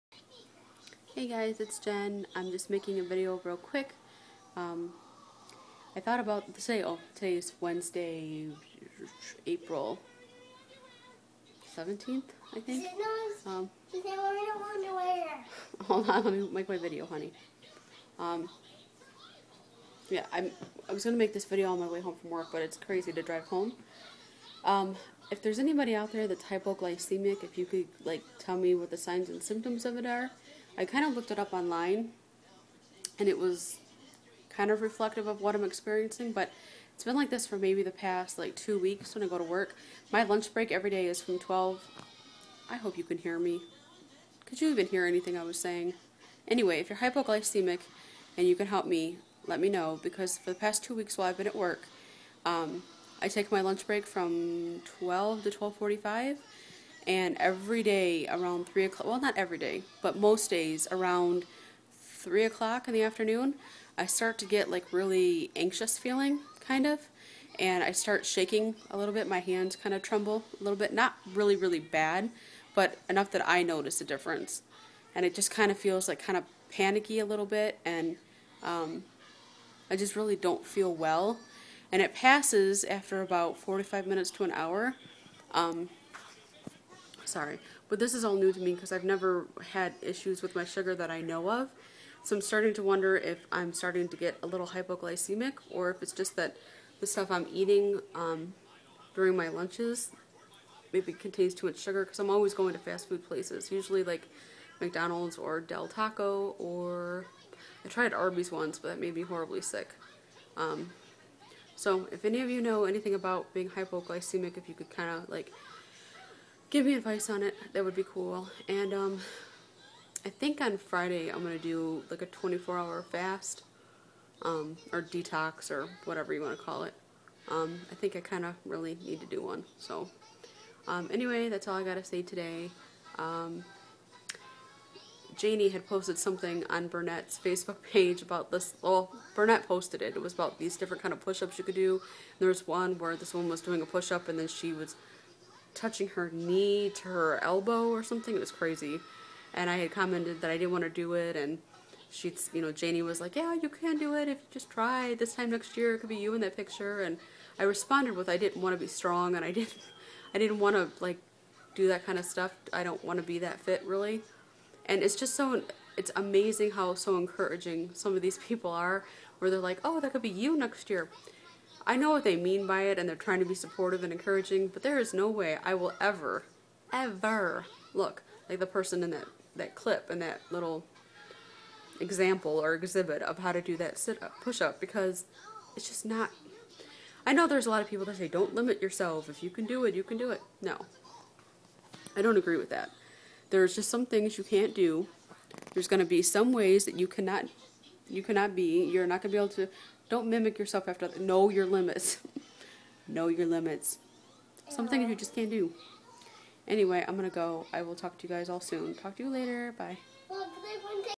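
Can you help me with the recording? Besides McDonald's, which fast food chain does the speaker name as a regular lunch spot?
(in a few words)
Del Taco.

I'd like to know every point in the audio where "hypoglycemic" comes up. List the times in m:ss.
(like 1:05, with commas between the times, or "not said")
0:26, 0:46, 1:34, 1:53.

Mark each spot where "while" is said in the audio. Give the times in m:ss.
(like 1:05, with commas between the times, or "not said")
0:51.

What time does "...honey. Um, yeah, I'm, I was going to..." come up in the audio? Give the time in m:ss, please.
0:17.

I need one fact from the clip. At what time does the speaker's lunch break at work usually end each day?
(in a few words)
12:45.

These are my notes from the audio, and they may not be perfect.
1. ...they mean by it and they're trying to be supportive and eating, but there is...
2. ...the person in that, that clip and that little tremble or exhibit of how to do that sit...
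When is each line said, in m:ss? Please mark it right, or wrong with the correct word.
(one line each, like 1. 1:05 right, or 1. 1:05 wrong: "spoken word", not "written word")
1. 2:52 wrong: "encouraging", not "eating"
2. 2:58 wrong: "example", not "tremble".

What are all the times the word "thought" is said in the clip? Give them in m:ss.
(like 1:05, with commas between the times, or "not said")
0:05.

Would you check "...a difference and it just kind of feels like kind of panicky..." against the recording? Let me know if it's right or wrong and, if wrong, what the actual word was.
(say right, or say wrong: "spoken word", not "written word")
right.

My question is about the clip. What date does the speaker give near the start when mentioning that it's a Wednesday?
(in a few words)
April 17th.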